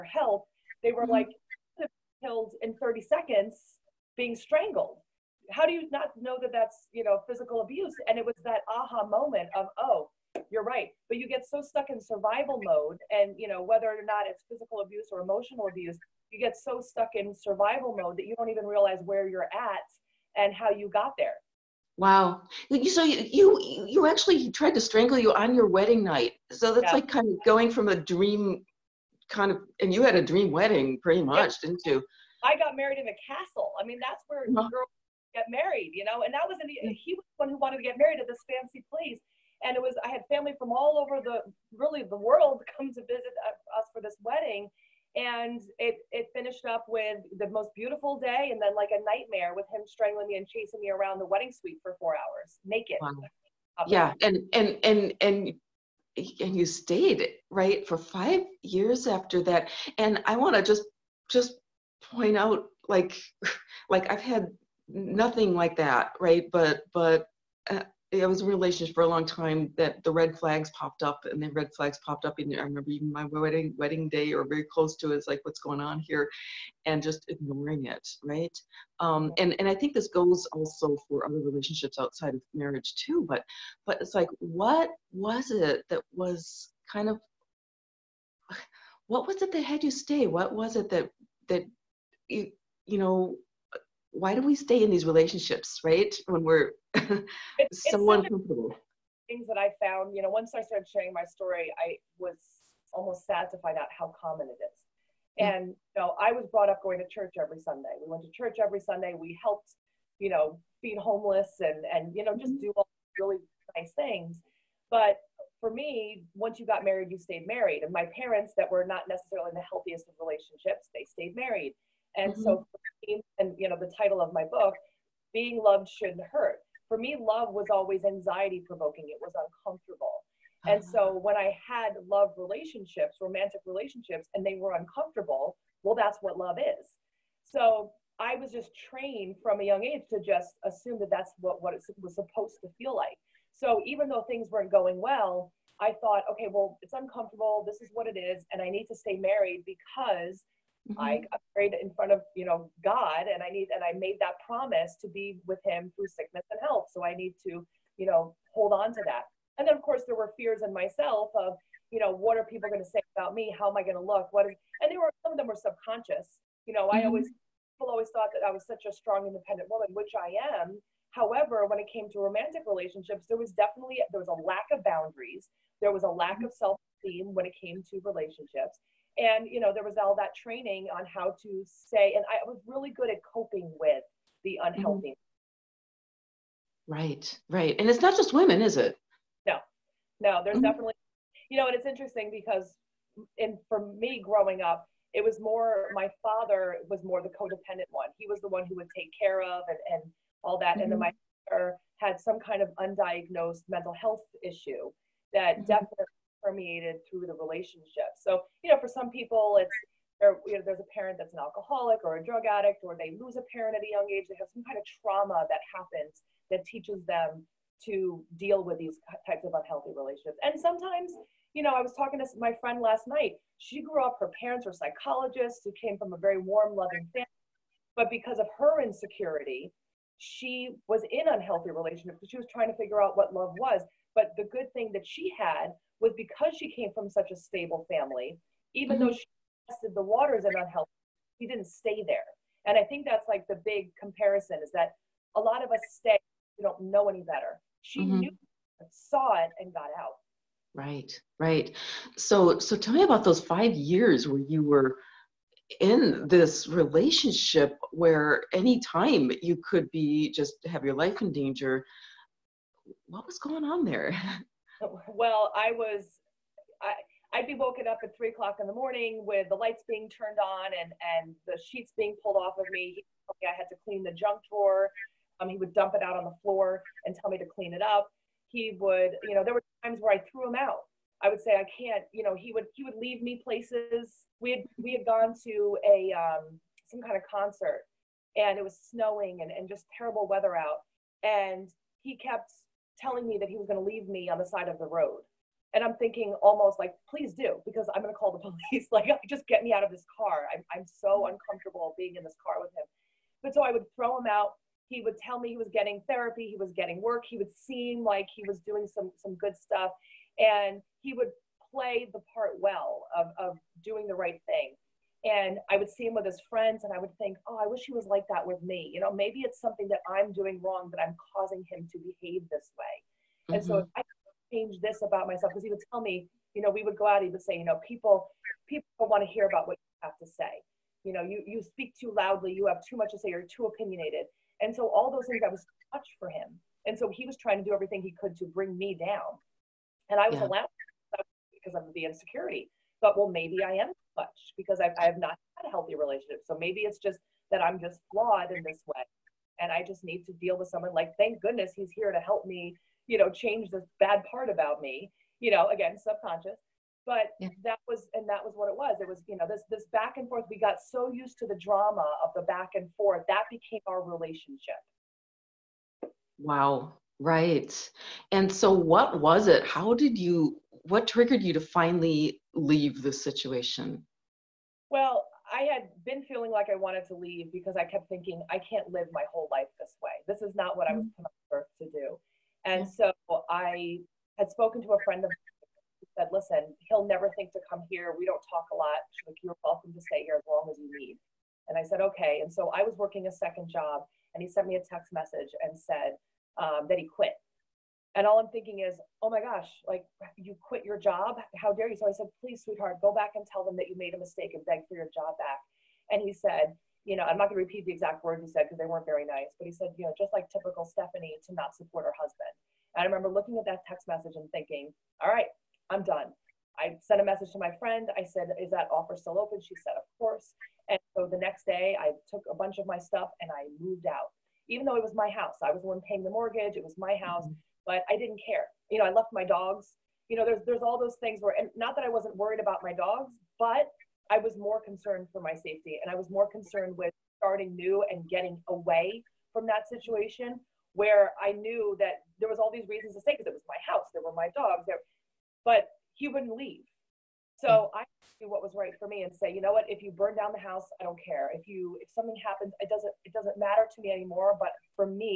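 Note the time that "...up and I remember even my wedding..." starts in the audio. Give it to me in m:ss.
1:12.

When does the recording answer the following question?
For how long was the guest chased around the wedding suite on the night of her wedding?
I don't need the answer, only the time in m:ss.
0:51.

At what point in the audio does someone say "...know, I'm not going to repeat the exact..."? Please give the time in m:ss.
6:47.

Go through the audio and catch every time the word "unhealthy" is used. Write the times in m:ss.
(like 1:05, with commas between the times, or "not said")
3:04, 3:39, 3:51, 4:00.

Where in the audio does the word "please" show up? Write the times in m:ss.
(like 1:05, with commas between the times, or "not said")
4:57, 6:42.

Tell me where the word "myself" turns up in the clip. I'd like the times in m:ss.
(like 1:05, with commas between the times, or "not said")
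2:40, 5:25.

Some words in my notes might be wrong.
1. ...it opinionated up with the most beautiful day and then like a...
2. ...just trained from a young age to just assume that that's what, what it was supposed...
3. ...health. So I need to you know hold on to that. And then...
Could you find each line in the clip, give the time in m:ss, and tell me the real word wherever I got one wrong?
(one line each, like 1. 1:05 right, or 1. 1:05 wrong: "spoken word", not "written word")
1. 0:46 wrong: "finished", not "opinionated"
2. 2:18 right
3. 2:36 right.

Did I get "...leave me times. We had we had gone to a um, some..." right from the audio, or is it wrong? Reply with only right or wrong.
wrong.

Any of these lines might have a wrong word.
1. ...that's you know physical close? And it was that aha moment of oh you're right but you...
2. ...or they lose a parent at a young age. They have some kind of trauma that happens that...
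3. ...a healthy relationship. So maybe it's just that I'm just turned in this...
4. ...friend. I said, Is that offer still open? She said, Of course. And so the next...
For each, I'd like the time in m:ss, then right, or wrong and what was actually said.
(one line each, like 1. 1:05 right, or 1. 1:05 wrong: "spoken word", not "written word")
1. 0:06 wrong: "abuse", not "close"
2. 3:32 right
3. 5:45 wrong: "flawed", not "turned"
4. 6:57 right.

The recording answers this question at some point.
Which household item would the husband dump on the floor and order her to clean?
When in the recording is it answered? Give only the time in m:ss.
4:34.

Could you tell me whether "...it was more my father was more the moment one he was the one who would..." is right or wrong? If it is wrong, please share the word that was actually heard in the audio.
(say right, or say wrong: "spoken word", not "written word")
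wrong: "codependent", not "moment".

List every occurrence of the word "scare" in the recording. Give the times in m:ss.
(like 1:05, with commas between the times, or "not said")
not said.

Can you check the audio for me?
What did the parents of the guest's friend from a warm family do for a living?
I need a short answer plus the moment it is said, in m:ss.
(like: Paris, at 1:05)
Psychologists, at 3:44.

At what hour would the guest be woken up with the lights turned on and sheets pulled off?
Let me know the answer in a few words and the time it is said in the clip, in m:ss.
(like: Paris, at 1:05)
3 o'clock, at 4:28.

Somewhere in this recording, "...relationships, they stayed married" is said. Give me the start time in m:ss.
2:00.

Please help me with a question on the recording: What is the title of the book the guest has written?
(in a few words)
Being Loved Shouldn't Hurt.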